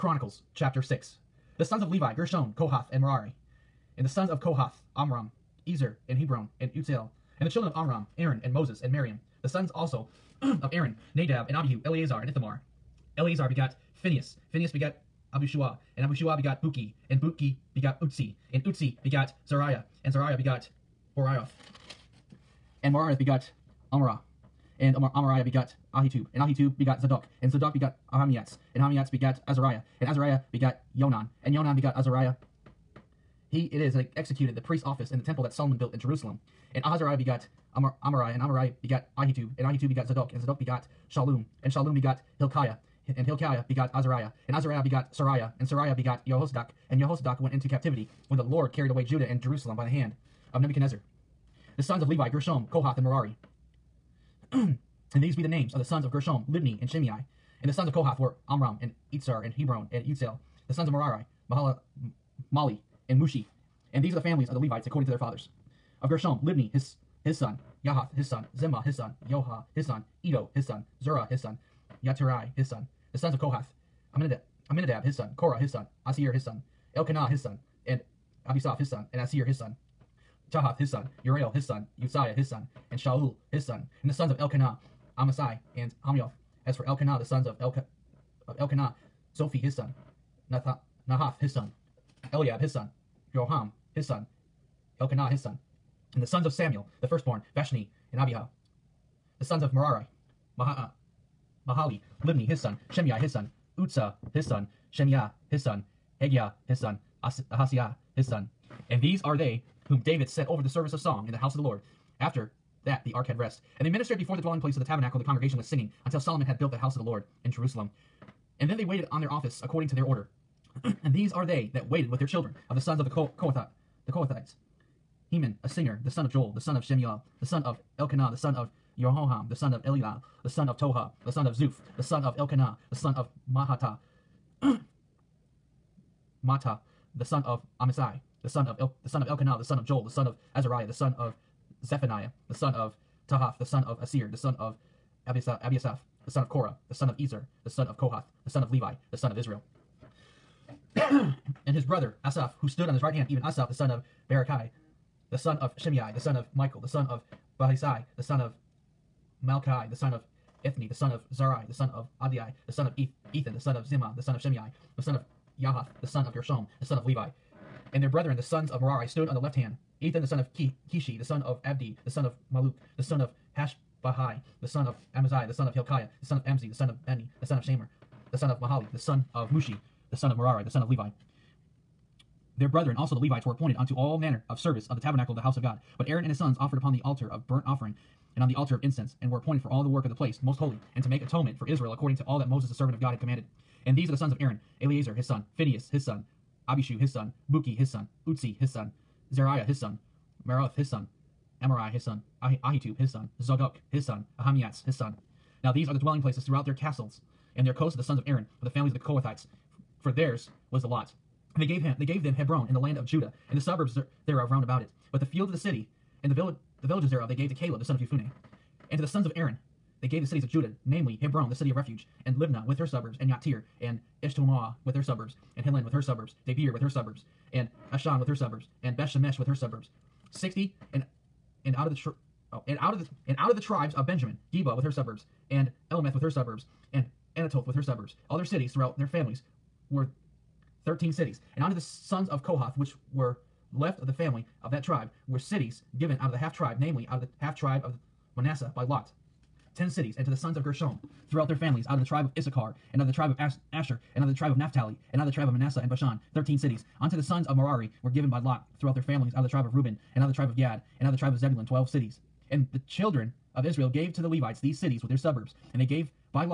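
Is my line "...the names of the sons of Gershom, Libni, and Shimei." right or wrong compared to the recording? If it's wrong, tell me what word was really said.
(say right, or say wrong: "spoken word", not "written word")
right.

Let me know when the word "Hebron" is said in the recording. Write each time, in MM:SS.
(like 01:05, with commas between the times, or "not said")
00:06, 00:59, 03:32, 03:41.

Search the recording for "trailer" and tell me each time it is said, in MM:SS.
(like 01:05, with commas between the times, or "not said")
not said.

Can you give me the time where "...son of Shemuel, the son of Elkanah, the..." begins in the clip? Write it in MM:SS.
02:06.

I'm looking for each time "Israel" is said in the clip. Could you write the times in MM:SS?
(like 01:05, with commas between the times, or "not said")
02:29, 03:11, 04:23.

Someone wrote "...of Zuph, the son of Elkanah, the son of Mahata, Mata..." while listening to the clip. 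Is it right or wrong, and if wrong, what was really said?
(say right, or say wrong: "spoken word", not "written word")
right.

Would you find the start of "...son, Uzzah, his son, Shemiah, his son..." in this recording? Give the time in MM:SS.
01:43.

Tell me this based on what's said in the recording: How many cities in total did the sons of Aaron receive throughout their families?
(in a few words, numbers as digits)
13.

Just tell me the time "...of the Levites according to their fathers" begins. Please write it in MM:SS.
01:04.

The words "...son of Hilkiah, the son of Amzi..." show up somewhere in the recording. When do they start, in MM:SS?
02:55.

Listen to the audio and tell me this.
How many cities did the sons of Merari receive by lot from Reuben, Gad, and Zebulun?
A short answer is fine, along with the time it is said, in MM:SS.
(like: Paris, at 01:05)
12, at 04:21.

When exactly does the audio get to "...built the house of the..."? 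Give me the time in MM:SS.
01:56.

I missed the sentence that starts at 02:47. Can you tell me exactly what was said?
And their brethren, the sons of Merari, stood on the left hand.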